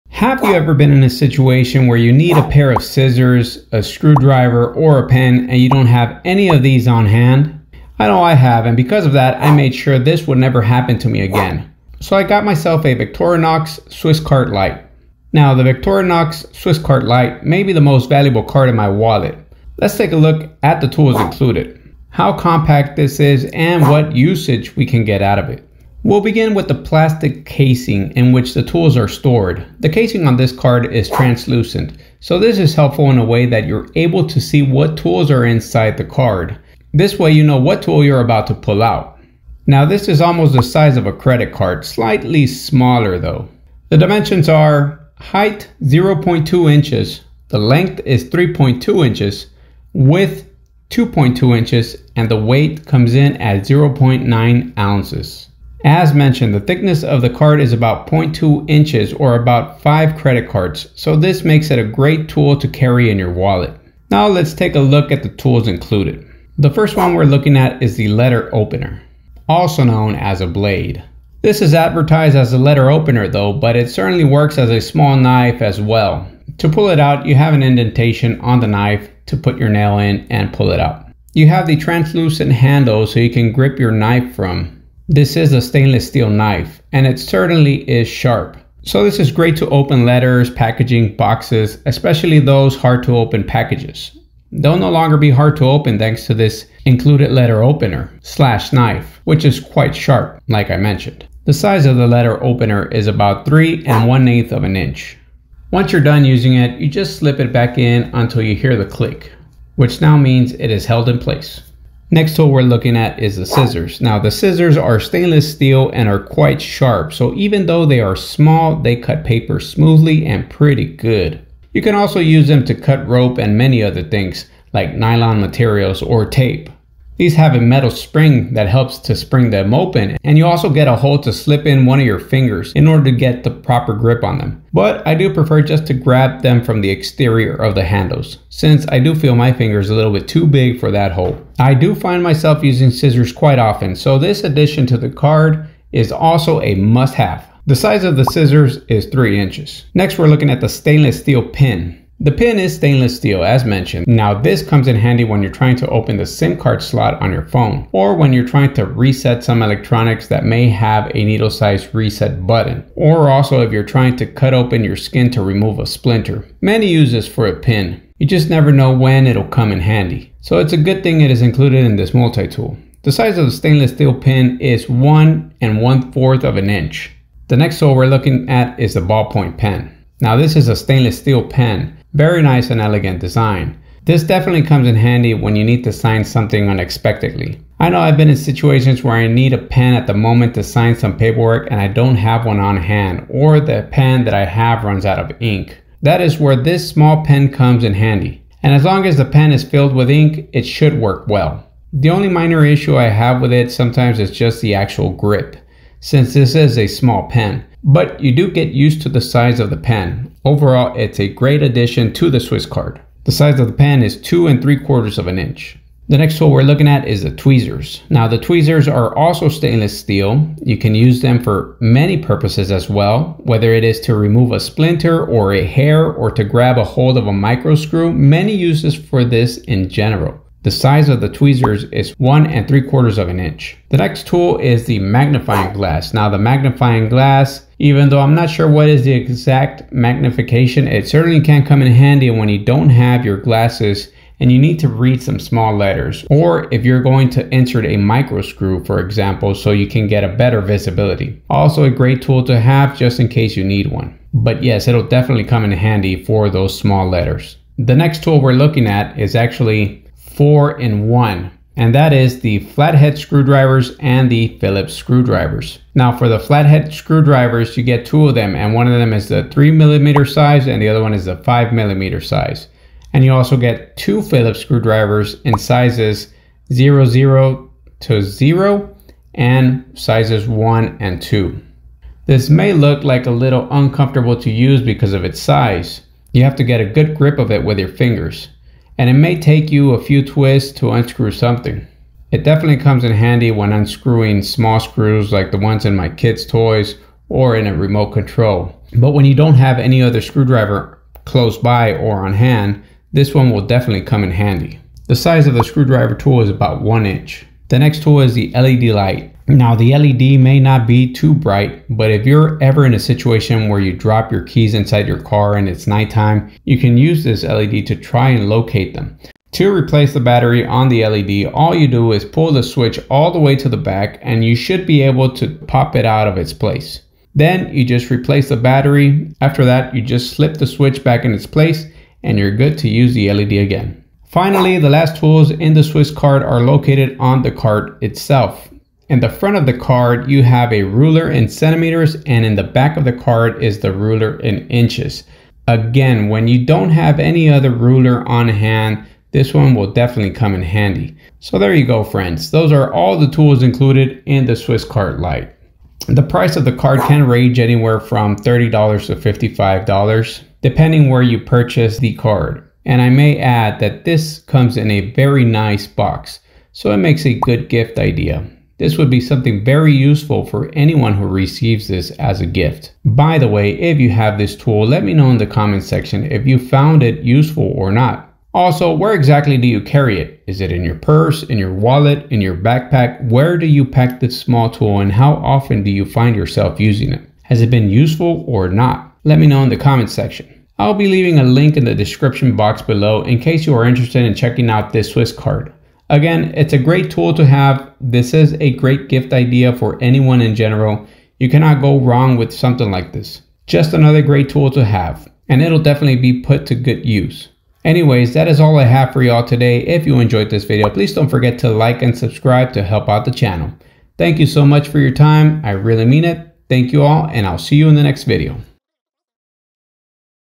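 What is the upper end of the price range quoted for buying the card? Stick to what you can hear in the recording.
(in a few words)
$55.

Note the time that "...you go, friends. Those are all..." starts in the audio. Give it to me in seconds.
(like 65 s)
351 s.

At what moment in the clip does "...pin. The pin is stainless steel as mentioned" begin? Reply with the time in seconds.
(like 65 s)
151 s.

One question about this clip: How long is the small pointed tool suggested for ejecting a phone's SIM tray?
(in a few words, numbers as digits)
1 1/4 inches.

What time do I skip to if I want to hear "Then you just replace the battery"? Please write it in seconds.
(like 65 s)
327 s.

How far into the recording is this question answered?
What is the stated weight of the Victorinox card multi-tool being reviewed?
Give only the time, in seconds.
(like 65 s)
53 s.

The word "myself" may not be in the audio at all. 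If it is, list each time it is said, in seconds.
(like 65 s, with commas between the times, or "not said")
12 s, 142 s.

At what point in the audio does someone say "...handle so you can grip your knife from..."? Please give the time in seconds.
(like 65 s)
82 s.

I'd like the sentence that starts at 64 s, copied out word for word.
Now let's take a look at the tools included.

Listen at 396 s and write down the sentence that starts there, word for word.
Again, it's a great tool to have.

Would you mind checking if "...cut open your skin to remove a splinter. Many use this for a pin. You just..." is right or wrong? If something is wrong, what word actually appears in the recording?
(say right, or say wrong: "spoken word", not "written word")
right.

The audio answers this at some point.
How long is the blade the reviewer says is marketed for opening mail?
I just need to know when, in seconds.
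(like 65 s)
103 s.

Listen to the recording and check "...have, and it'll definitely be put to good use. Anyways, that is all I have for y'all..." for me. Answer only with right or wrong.
right.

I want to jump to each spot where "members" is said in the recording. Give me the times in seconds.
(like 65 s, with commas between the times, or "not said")
not said.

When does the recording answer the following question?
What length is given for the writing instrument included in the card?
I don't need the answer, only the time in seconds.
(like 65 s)
214 s.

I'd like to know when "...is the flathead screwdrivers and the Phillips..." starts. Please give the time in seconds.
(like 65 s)
262 s.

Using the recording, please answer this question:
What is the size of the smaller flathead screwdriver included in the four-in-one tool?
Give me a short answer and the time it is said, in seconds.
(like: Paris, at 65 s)
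3 millimeters, at 269 s.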